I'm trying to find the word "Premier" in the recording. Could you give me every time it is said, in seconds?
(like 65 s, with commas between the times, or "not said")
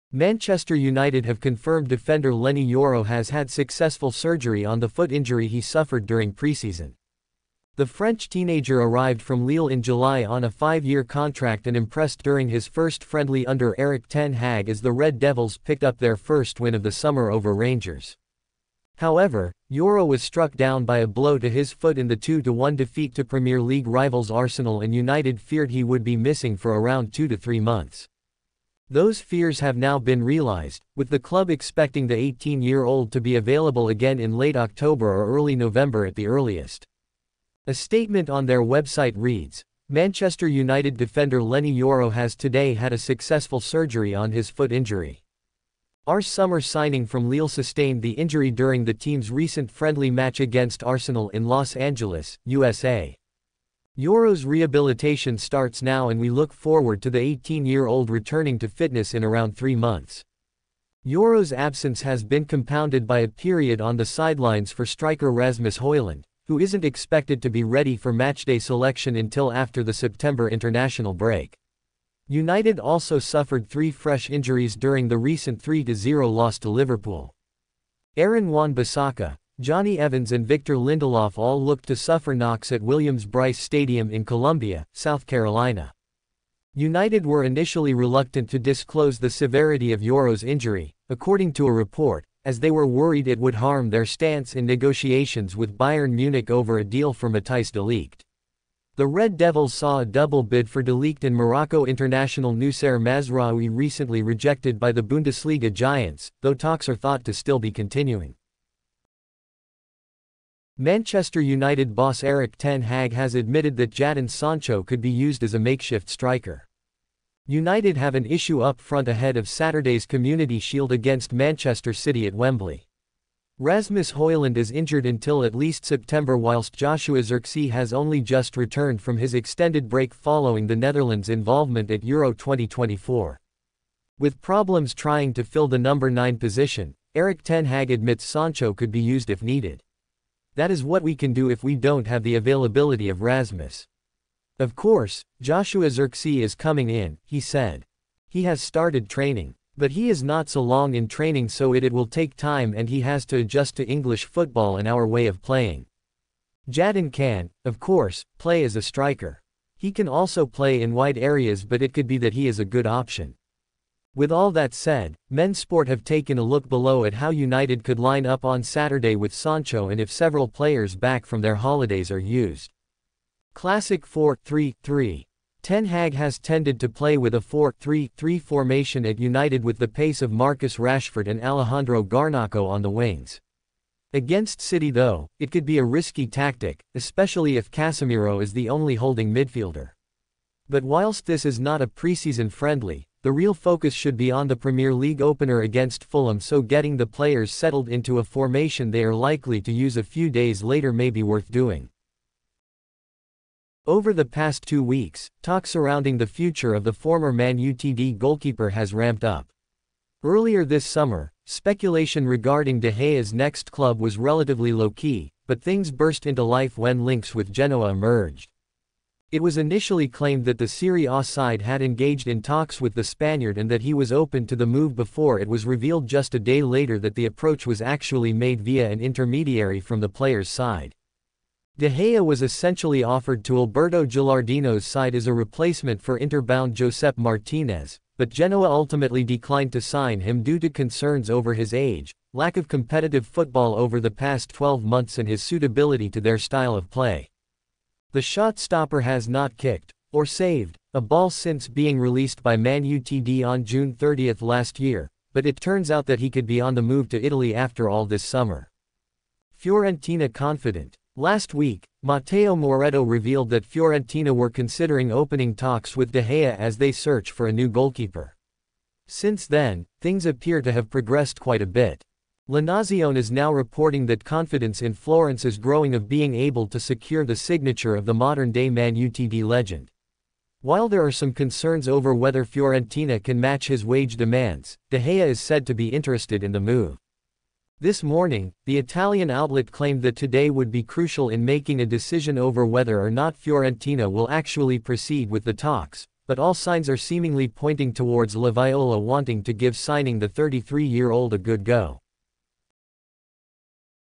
23 s, 194 s.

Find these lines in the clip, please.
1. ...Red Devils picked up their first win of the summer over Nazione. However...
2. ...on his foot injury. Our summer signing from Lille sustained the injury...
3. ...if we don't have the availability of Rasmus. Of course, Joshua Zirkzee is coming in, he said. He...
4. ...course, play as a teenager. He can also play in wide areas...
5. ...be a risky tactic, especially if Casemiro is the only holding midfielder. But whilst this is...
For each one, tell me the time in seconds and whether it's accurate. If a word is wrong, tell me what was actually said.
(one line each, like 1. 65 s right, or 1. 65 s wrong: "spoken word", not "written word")
1. 14 s wrong: "Rangers", not "Nazione"
2. 44 s right
3. 141 s right
4. 157 s wrong: "striker", not "teenager"
5. 185 s right.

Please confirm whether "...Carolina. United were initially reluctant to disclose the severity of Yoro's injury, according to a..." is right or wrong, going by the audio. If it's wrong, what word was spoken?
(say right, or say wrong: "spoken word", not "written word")
right.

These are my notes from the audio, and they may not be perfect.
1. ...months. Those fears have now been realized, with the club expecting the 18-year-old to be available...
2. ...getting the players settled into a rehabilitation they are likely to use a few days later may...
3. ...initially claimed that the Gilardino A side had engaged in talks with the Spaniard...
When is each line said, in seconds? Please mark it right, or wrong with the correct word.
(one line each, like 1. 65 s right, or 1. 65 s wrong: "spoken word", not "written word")
1. 27 s right
2. 196 s wrong: "formation", not "rehabilitation"
3. 219 s wrong: "Serie", not "Gilardino".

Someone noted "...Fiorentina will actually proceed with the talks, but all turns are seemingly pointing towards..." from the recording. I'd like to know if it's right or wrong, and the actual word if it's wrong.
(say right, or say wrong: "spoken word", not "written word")
wrong: "signs", not "turns".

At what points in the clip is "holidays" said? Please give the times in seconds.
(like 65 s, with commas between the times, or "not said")
171 s.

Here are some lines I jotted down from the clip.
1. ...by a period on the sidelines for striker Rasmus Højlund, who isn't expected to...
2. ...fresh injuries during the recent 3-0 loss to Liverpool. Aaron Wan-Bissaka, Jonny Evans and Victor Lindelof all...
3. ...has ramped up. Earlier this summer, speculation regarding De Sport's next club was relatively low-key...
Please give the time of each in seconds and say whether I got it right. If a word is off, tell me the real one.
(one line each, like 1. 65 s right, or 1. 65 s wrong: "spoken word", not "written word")
1. 63 s right
2. 73 s right
3. 208 s wrong: "Gea", not "Sport".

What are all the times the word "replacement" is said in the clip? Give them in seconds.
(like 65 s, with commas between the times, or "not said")
235 s.